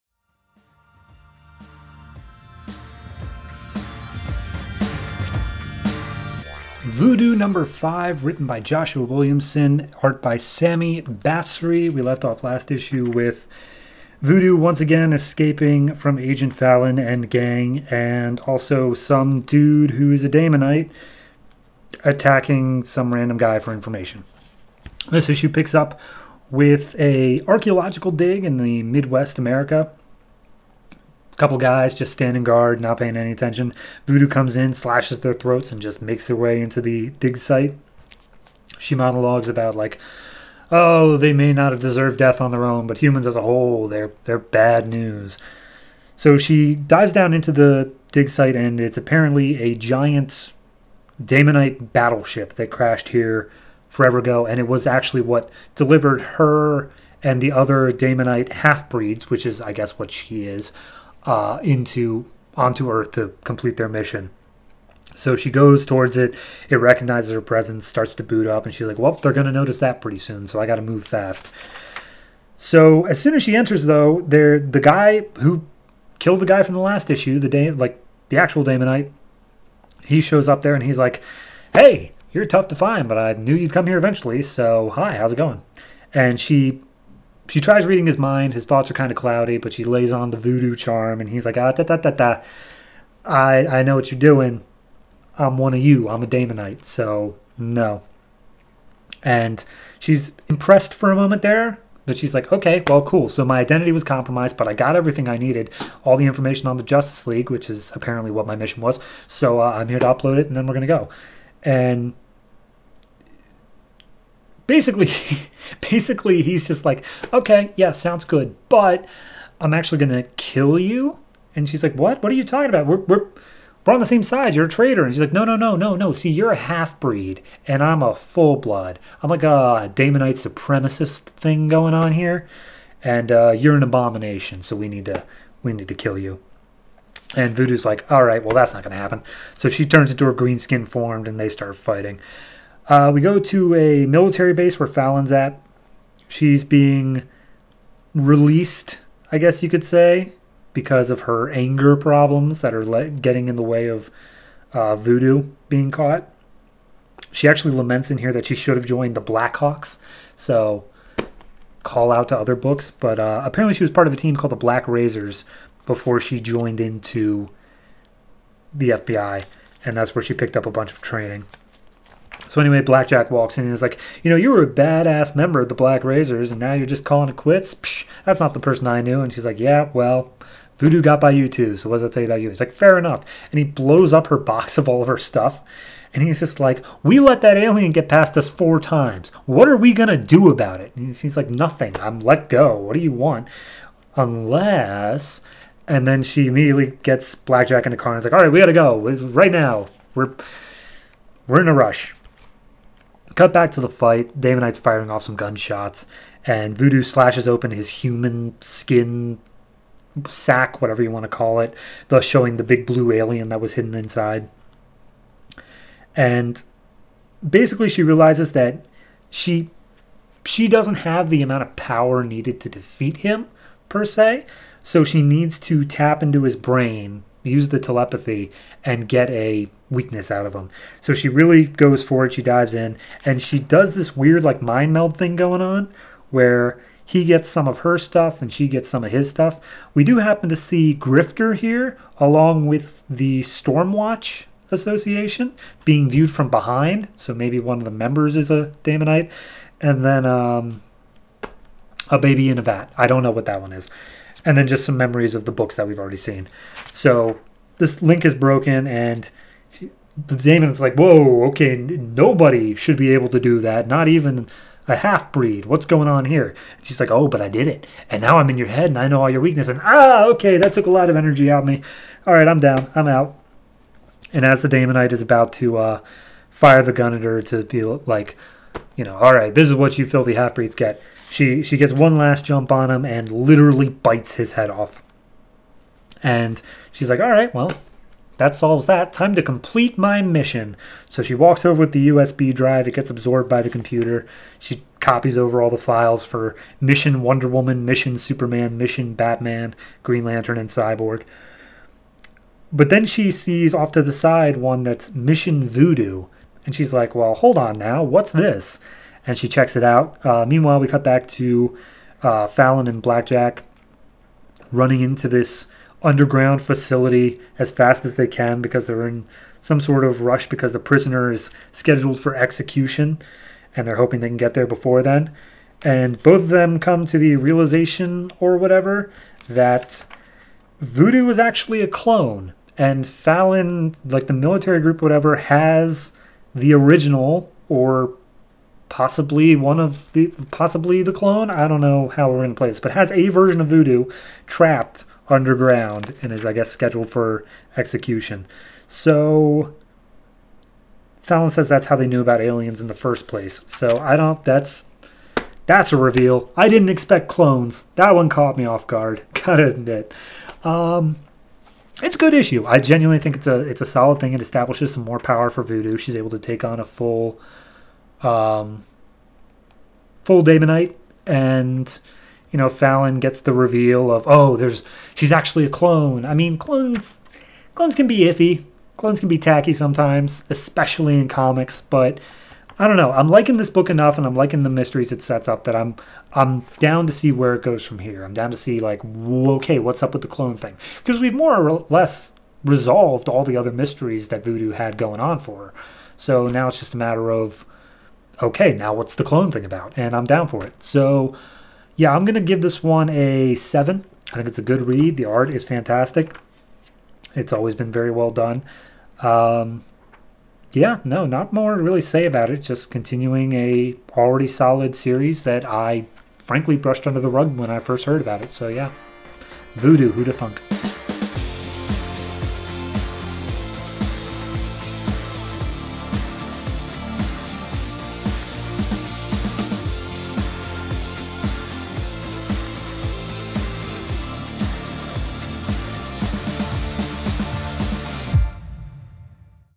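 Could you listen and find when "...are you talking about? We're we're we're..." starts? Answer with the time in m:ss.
2:02.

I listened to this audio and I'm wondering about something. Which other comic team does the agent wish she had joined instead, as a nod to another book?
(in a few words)
Blackhawks.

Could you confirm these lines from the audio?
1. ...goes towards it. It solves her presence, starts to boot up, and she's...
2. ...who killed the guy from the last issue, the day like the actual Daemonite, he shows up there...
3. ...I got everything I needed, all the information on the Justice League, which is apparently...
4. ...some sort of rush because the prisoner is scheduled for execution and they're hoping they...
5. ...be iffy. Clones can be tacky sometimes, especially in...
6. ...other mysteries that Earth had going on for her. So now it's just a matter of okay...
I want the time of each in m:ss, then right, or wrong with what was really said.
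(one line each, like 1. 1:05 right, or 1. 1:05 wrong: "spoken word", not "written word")
1. 1:05 wrong: "recognizes", not "solves"
2. 1:15 right
3. 1:44 right
4. 5:19 right
5. 6:18 right
6. 6:33 wrong: "Voodoo", not "Earth".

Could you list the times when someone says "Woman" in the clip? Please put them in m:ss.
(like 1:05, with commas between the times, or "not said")
4:57.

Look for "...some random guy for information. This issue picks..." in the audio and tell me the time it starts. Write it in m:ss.
0:22.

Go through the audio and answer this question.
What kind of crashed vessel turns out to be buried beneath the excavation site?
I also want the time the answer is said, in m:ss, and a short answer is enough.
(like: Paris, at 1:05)
Daemonite battleship, at 0:51.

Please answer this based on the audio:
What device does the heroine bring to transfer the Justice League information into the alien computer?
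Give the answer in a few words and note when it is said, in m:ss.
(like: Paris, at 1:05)
USB drive, at 4:52.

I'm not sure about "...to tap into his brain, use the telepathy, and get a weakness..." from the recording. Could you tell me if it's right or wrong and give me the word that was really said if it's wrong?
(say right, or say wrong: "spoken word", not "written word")
right.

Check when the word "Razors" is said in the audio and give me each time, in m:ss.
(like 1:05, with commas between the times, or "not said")
2:44, 2:56.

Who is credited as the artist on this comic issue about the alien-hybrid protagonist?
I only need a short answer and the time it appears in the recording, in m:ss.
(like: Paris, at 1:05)
Sami Basri, at 0:10.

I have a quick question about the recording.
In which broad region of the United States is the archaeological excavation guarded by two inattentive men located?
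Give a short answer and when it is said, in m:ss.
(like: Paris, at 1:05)
Midwest, at 0:28.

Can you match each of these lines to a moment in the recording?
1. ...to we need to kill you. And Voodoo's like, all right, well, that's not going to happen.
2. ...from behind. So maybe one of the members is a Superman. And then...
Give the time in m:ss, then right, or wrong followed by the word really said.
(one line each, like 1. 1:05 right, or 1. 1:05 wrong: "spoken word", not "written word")
1. 2:15 right
2. 4:06 wrong: "Daemonite", not "Superman".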